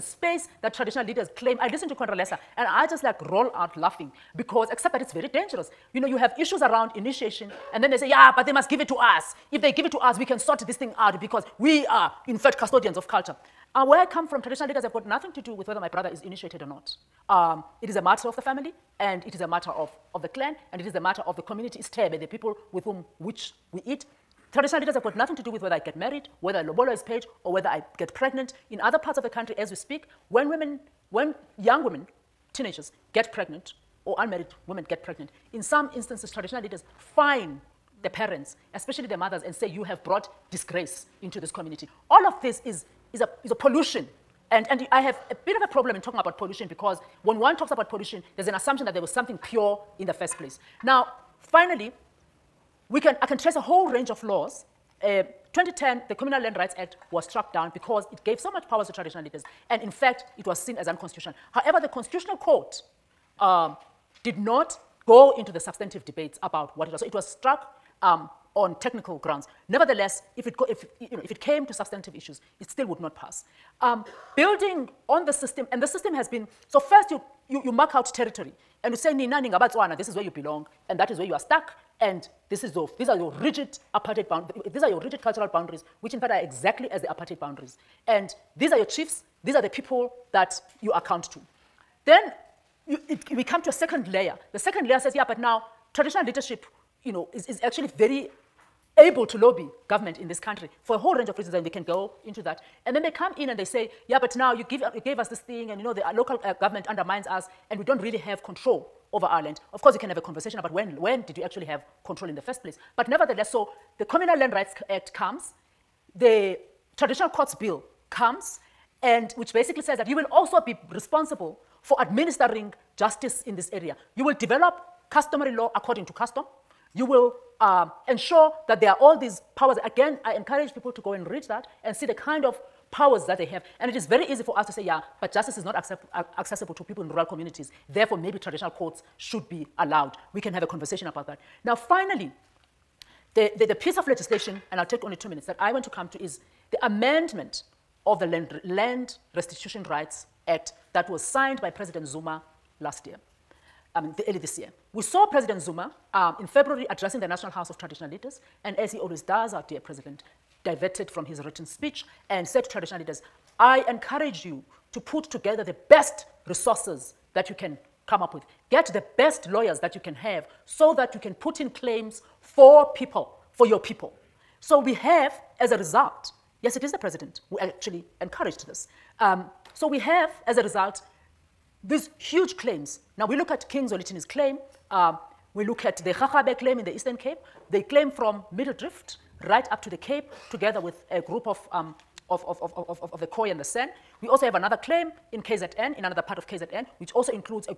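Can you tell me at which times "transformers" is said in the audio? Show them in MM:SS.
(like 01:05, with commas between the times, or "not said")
not said.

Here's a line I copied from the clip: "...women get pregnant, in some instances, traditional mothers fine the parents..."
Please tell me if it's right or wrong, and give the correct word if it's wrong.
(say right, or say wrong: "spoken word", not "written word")
wrong: "leaders", not "mothers".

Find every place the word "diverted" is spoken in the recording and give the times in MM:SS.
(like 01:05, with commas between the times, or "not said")
02:40.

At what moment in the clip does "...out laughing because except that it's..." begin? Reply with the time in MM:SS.
00:03.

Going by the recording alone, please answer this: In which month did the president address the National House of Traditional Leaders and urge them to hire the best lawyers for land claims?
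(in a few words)
February.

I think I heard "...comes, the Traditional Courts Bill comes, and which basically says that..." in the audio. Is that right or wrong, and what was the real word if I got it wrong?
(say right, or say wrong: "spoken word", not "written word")
right.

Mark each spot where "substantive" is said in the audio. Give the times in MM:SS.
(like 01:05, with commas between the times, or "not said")
01:05, 01:11.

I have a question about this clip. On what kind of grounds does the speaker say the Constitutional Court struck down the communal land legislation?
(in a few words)
Technical grounds.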